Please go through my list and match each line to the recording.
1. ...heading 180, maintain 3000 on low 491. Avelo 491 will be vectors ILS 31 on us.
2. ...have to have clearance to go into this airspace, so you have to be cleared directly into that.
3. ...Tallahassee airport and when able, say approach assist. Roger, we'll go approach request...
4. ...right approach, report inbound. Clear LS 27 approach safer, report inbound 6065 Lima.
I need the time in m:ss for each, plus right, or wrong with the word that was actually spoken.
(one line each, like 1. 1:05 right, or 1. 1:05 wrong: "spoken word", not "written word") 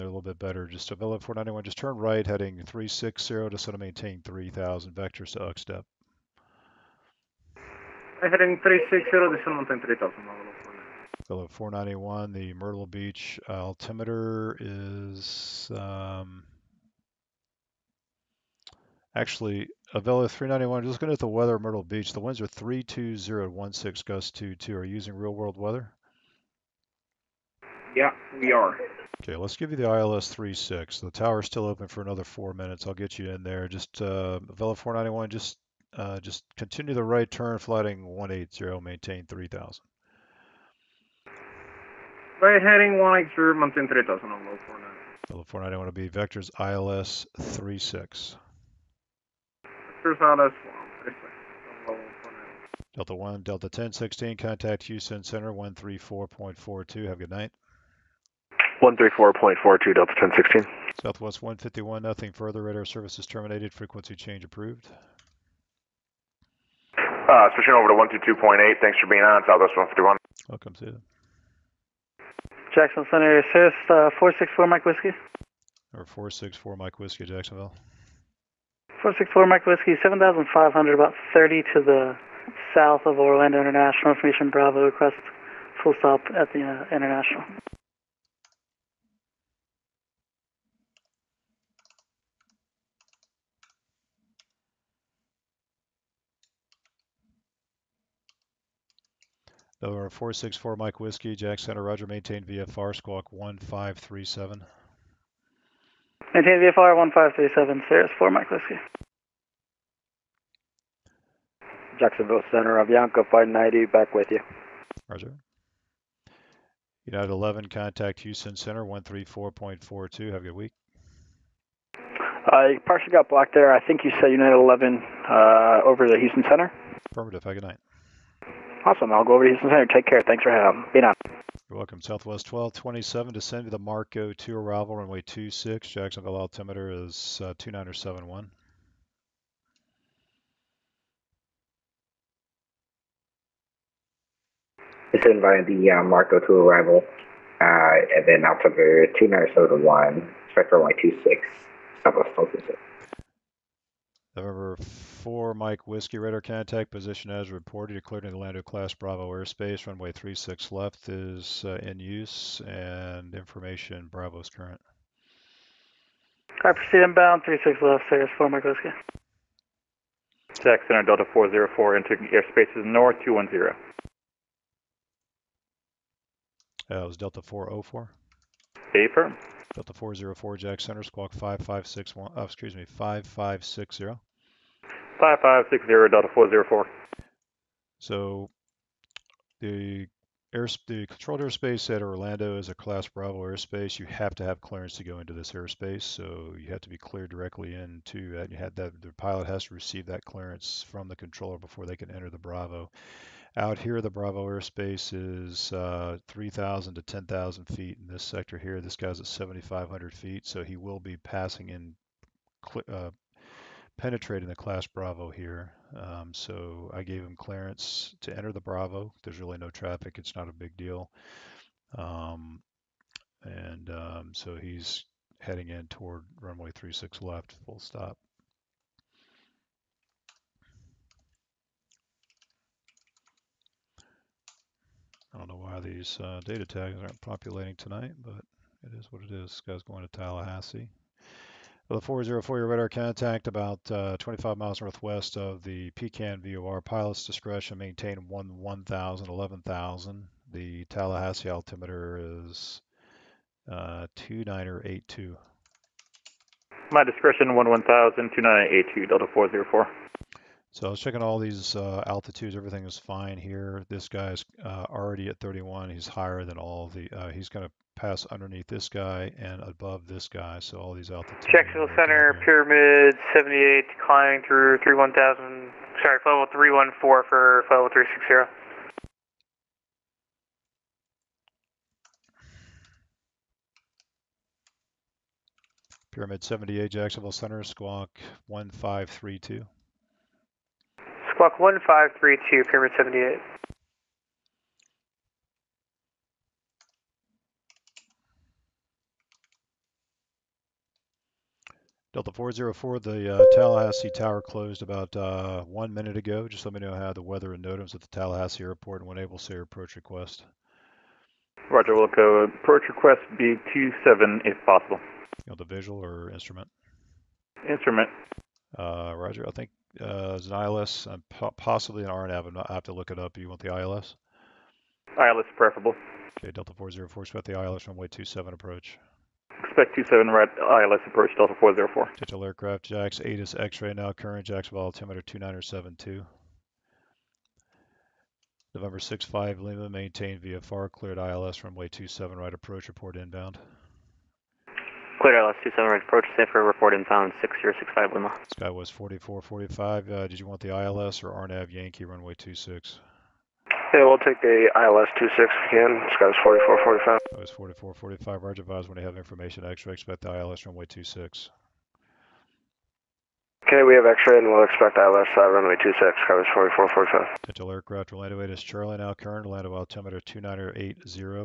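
1. 0:42 wrong: "36", not "31"
2. 3:14 right
3. 5:08 wrong: "request", not "assist"
4. 5:42 right.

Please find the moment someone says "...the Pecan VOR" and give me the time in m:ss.
4:05.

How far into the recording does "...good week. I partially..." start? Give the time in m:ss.
2:00.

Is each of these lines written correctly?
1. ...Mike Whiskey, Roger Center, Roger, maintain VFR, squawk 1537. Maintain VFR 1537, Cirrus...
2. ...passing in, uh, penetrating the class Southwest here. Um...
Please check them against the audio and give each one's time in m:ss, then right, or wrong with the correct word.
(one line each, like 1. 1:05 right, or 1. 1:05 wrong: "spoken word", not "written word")
1. 1:40 wrong: "Jack", not "Roger"
2. 3:31 wrong: "Bravo", not "Southwest".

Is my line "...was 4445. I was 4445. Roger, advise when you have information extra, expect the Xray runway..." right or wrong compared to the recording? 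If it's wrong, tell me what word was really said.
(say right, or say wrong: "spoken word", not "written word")
wrong: "ILS", not "Xray".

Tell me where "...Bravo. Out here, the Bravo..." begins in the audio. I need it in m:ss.
3:22.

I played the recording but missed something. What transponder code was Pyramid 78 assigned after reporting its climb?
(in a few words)
1532.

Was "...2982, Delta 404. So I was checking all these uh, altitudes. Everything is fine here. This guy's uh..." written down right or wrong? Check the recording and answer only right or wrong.
right.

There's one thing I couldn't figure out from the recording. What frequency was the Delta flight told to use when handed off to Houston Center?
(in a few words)
134.42.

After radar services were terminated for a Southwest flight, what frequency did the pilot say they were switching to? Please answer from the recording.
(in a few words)
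122.8.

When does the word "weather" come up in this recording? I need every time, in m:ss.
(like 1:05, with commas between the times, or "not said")
0:21, 0:25, 5:07.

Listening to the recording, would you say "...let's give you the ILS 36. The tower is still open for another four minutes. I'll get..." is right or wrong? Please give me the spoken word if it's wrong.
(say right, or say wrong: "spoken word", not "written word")
right.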